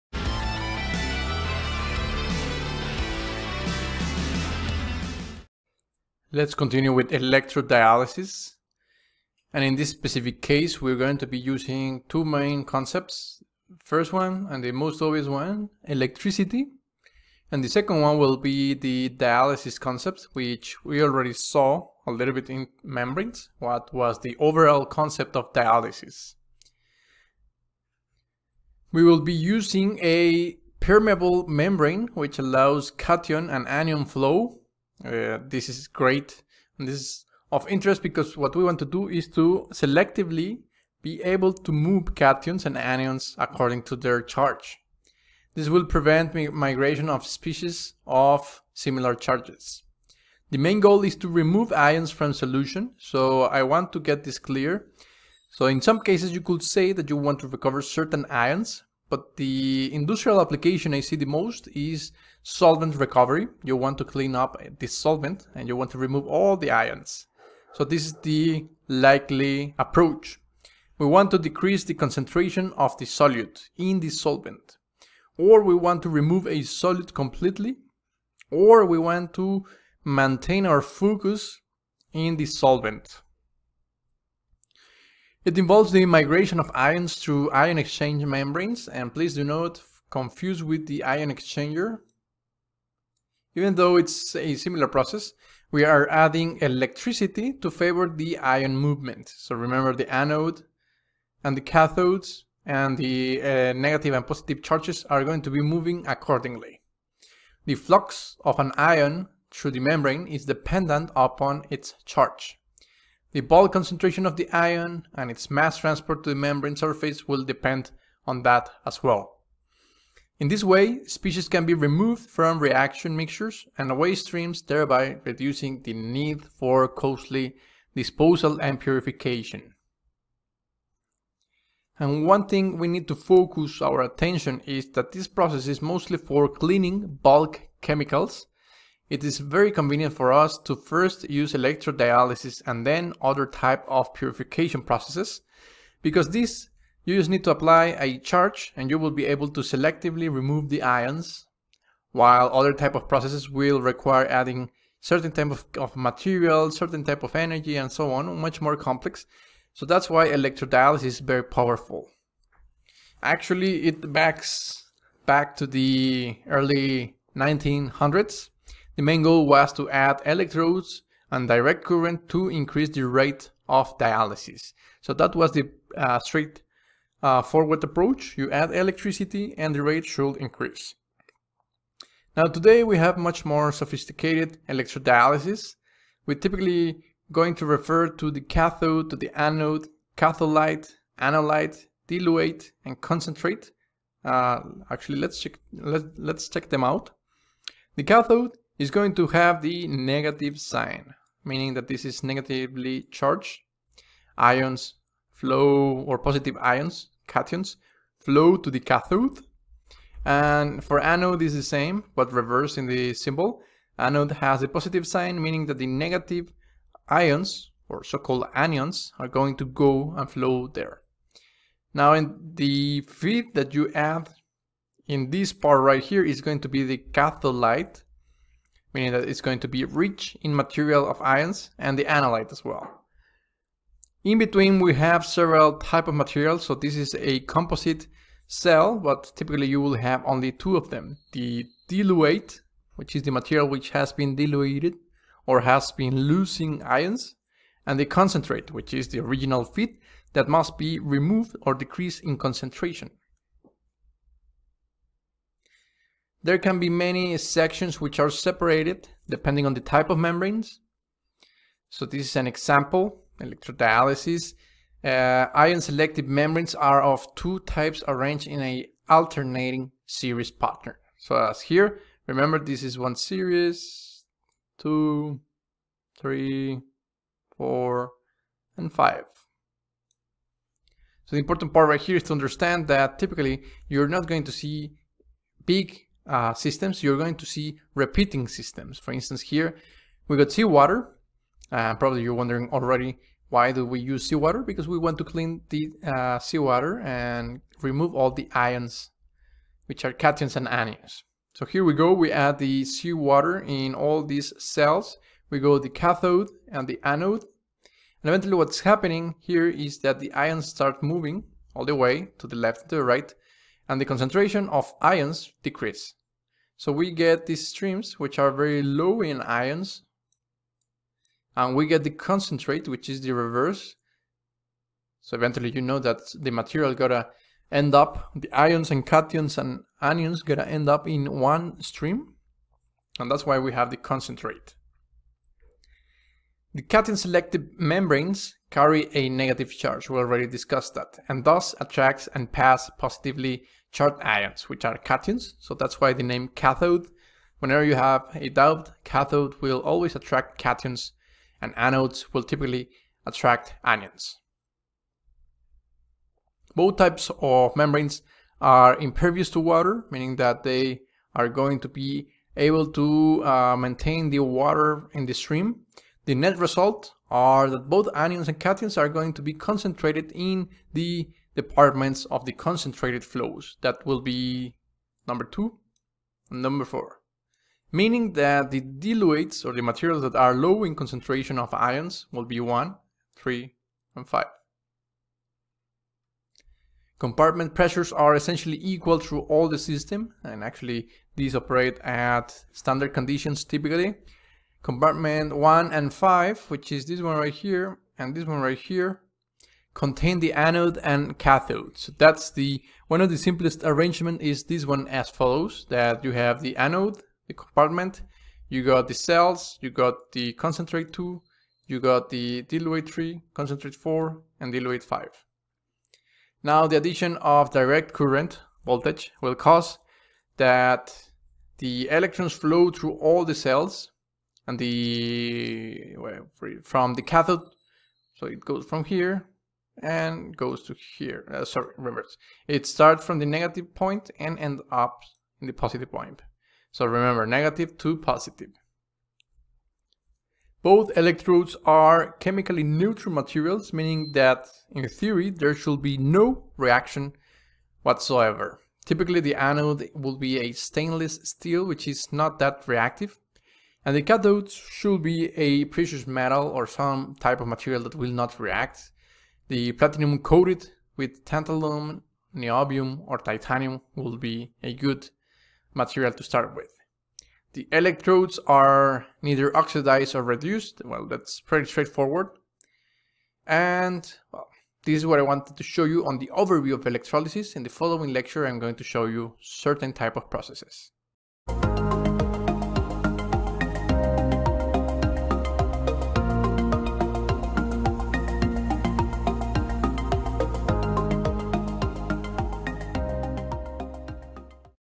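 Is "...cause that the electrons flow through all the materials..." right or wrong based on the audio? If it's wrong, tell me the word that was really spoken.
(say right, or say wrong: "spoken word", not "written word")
wrong: "cells", not "materials".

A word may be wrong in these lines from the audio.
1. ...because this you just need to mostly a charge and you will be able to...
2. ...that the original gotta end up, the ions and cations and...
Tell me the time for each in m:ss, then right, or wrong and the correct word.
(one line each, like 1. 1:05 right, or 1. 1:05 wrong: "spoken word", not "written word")
1. 2:26 wrong: "apply", not "mostly"
2. 5:25 wrong: "material", not "original".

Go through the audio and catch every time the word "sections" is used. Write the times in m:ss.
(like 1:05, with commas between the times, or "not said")
4:17.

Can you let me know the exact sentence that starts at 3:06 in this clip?
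We're typically going to refer to the cathode, to the anode, catholyte, anolyte, diluate, and concentrate.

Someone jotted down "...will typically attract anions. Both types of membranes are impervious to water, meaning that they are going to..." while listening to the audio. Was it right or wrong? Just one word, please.
right.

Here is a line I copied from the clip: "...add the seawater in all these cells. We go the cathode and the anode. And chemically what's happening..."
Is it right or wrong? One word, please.
wrong.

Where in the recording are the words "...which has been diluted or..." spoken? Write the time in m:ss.
4:03.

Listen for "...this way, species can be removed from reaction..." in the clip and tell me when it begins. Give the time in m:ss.
2:00.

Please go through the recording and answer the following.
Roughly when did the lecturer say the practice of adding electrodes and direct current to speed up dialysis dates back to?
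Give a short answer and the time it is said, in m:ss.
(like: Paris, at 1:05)
Early 1900s, at 2:46.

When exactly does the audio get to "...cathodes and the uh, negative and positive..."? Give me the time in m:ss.
1:41.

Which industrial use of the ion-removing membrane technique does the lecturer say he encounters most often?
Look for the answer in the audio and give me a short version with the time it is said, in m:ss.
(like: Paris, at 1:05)
Solvent recovery, at 1:02.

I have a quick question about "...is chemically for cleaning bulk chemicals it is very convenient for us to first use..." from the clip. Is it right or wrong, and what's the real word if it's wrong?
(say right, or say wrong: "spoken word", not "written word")
wrong: "mostly", not "chemically".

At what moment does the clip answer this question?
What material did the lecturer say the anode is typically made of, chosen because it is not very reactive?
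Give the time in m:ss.
7:30.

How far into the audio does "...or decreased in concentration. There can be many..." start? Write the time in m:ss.
4:11.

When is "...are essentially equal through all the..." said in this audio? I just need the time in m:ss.
6:28.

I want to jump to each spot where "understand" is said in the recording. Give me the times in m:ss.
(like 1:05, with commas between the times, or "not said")
4:42.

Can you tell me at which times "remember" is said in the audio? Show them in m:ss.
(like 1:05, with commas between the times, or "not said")
1:39, 4:32, 7:17.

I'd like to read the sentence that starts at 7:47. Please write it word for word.
The electrodes are neither oxidized or reduced, well that's pretty straightforward.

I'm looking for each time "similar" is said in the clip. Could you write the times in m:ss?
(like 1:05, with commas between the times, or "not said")
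0:48, 1:34.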